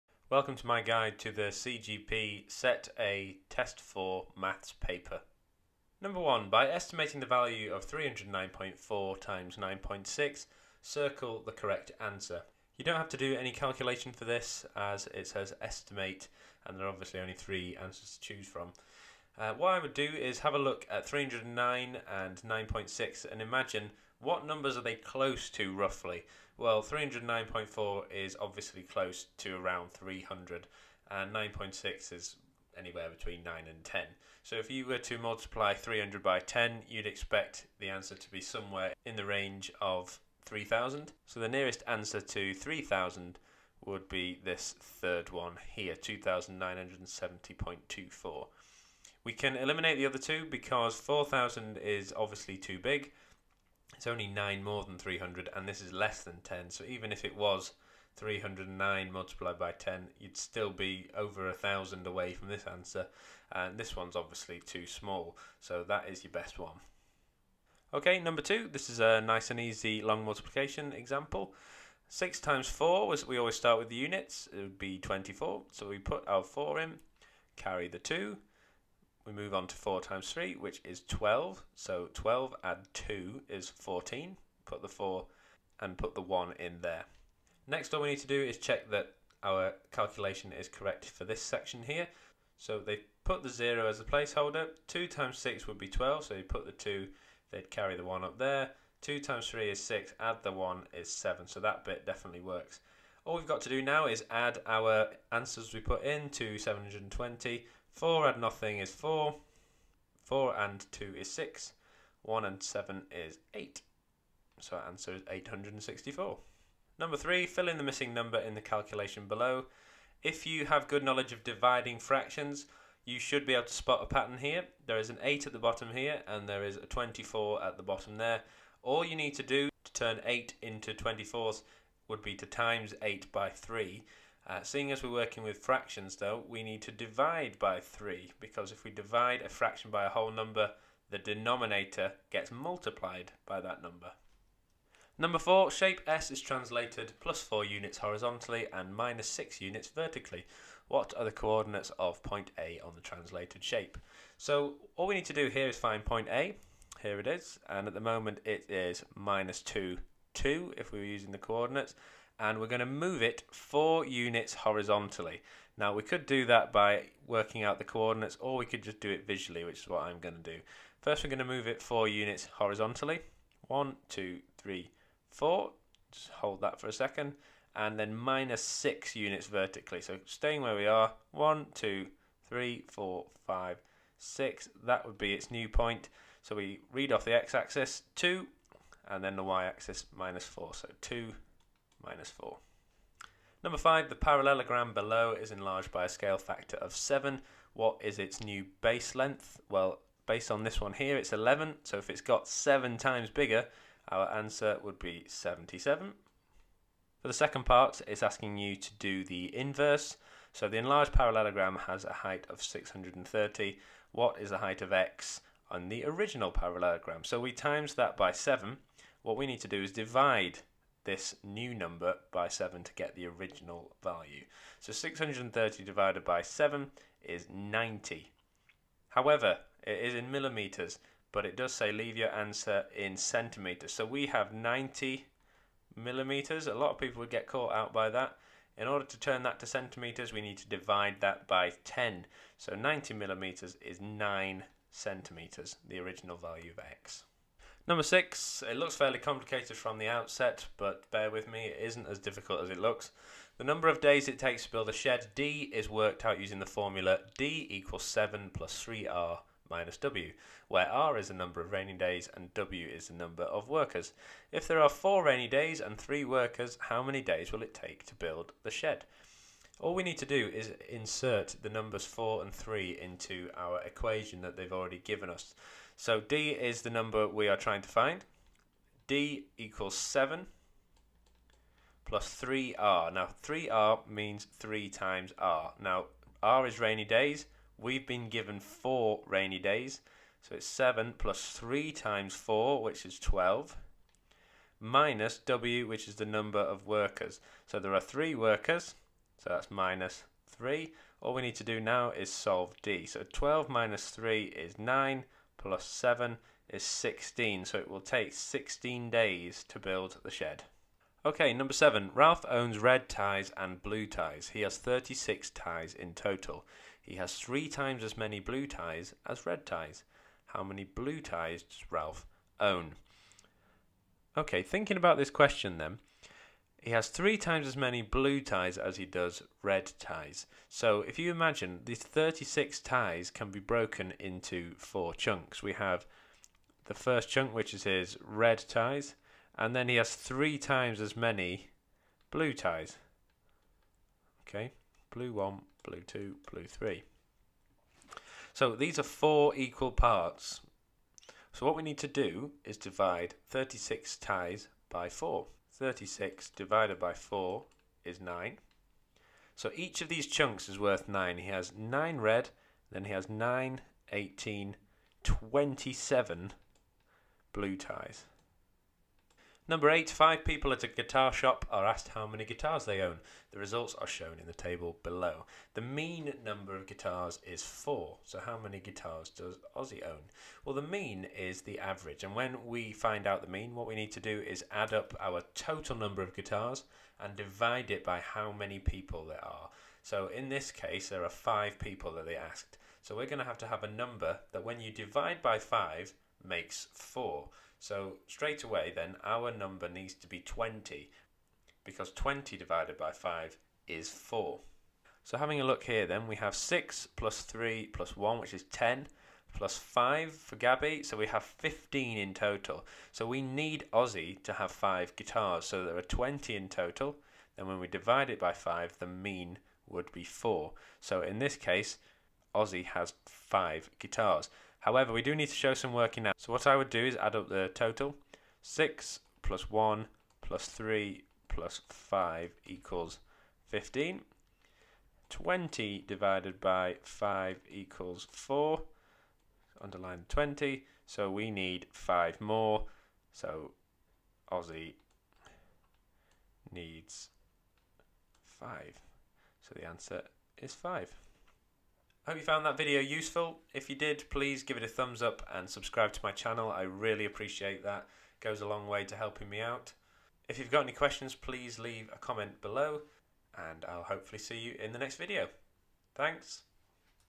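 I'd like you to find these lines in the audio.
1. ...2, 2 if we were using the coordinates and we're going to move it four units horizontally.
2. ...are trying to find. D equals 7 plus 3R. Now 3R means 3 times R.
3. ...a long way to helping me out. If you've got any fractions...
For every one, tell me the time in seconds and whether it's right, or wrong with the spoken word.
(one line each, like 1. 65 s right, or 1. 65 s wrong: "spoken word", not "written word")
1. 159 s right
2. 277 s right
3. 458 s wrong: "questions", not "fractions".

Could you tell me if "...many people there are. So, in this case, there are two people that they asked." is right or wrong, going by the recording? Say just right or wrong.
wrong.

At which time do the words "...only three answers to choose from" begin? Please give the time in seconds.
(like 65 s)
17 s.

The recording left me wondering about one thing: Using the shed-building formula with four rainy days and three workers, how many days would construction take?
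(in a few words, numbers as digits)
16.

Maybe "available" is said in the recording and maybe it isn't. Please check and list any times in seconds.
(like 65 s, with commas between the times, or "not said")
not said.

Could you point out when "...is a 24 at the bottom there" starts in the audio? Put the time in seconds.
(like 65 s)
126 s.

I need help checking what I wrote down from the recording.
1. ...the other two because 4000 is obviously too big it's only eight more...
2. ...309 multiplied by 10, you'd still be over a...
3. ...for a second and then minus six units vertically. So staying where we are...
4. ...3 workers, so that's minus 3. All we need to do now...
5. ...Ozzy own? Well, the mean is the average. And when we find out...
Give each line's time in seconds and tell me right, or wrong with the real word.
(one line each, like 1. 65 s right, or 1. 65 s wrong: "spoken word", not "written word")
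1. 49 s wrong: "nine", not "eight"
2. 58 s right
3. 176 s right
4. 298 s right
5. 379 s right.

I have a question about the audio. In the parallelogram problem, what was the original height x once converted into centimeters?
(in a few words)
9 centimeters.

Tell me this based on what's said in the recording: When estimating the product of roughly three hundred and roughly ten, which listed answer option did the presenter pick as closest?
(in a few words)
2970.24.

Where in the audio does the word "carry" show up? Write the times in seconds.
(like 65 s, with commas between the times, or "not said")
77 s, 97 s.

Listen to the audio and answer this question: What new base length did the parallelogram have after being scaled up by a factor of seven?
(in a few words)
77.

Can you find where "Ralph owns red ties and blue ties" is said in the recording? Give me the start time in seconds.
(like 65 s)
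312 s.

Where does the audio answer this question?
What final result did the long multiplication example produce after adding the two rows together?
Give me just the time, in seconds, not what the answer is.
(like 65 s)
115 s.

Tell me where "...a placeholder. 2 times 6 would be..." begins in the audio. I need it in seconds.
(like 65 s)
93 s.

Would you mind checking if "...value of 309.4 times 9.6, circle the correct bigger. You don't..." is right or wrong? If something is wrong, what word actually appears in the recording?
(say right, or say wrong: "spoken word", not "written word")
wrong: "answer", not "bigger".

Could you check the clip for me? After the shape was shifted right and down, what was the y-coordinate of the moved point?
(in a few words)
-4.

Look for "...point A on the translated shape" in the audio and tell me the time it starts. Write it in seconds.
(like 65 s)
152 s.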